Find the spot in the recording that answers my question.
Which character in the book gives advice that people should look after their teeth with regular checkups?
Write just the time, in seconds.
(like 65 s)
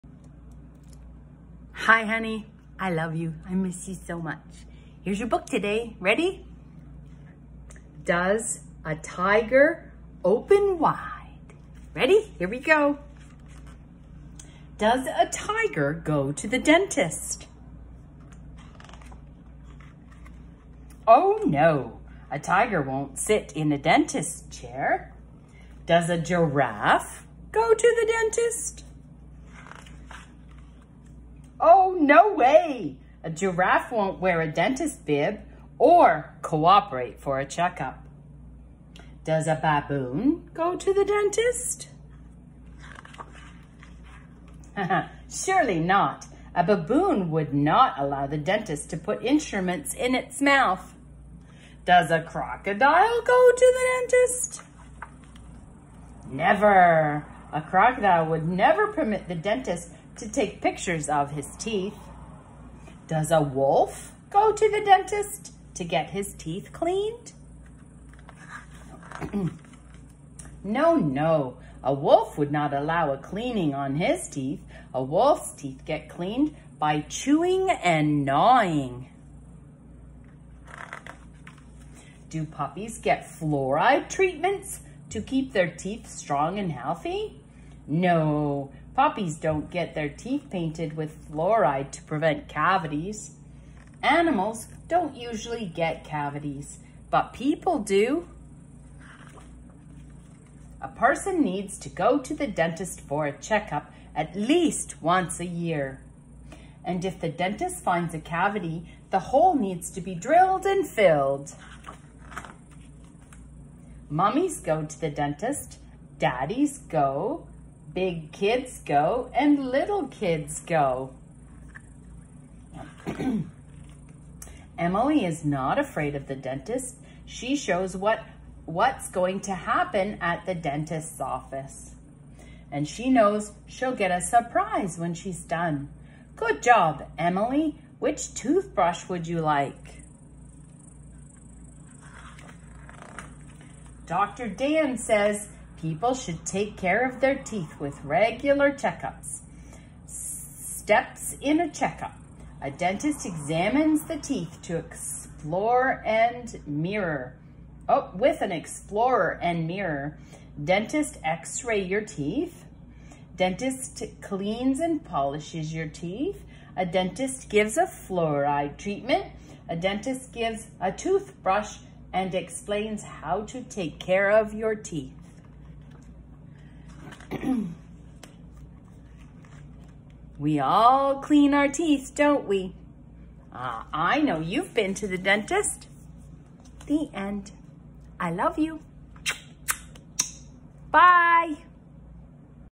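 144 s.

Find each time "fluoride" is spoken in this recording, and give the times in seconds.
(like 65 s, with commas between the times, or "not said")
83 s, 91 s, 167 s.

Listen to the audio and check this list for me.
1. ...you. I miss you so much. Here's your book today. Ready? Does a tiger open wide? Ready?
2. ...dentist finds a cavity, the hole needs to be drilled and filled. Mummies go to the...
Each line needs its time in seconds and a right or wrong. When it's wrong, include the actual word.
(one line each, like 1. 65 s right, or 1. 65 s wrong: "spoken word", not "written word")
1. 3 s right
2. 107 s right.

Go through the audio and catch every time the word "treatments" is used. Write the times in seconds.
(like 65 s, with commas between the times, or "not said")
84 s, 168 s.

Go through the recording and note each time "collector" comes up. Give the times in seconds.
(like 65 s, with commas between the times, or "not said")
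not said.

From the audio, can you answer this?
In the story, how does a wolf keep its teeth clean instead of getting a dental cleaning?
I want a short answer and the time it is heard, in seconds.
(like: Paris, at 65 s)
Chewing and gnawing, at 77 s.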